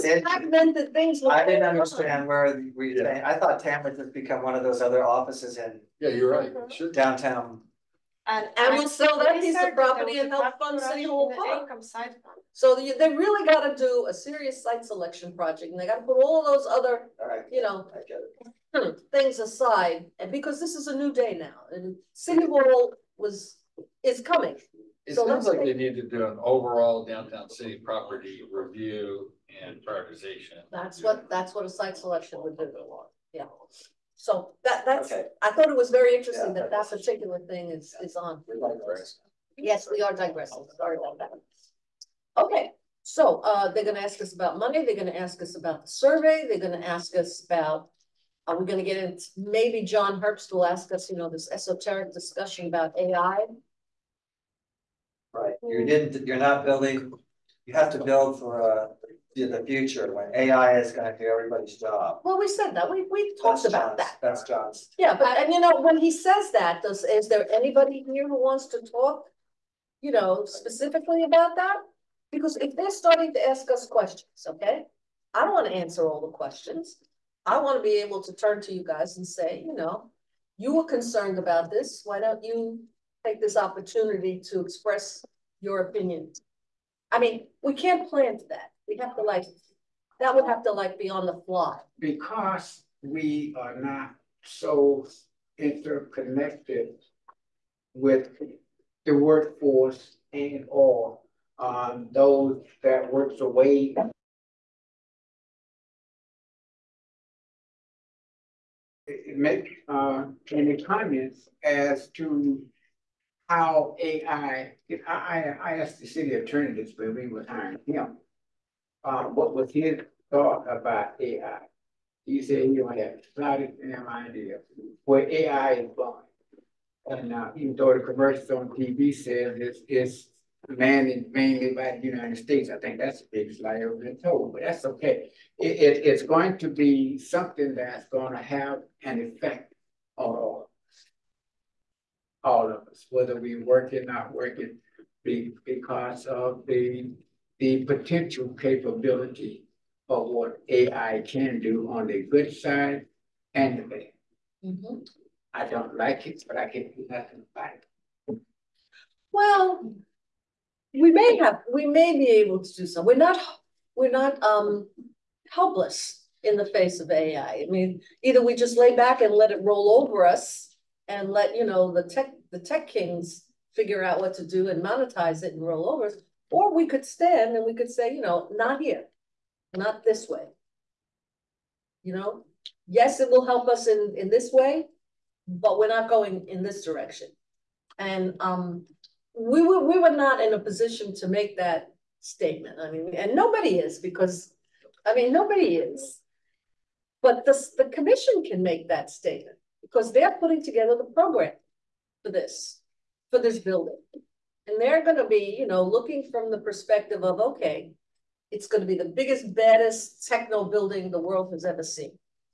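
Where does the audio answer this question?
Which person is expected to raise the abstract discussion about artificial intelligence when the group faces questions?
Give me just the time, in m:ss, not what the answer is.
0:49.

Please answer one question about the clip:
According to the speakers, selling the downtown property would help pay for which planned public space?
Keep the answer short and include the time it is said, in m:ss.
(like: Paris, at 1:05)
City Hall Park, at 0:10.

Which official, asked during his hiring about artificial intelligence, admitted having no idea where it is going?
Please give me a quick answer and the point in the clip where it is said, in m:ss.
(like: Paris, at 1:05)
city attorney, at 1:56.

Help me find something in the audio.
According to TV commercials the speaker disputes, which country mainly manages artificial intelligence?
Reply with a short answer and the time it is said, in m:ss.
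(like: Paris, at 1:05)
United States, at 2:12.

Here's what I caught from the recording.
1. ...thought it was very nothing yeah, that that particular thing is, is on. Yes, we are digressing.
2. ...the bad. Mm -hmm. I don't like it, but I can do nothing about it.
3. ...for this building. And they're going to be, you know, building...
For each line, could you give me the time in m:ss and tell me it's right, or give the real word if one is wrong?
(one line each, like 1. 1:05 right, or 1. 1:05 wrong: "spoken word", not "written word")
1. 0:35 wrong: "interesting", not "nothing"
2. 2:33 right
3. 3:23 wrong: "looking", not "building".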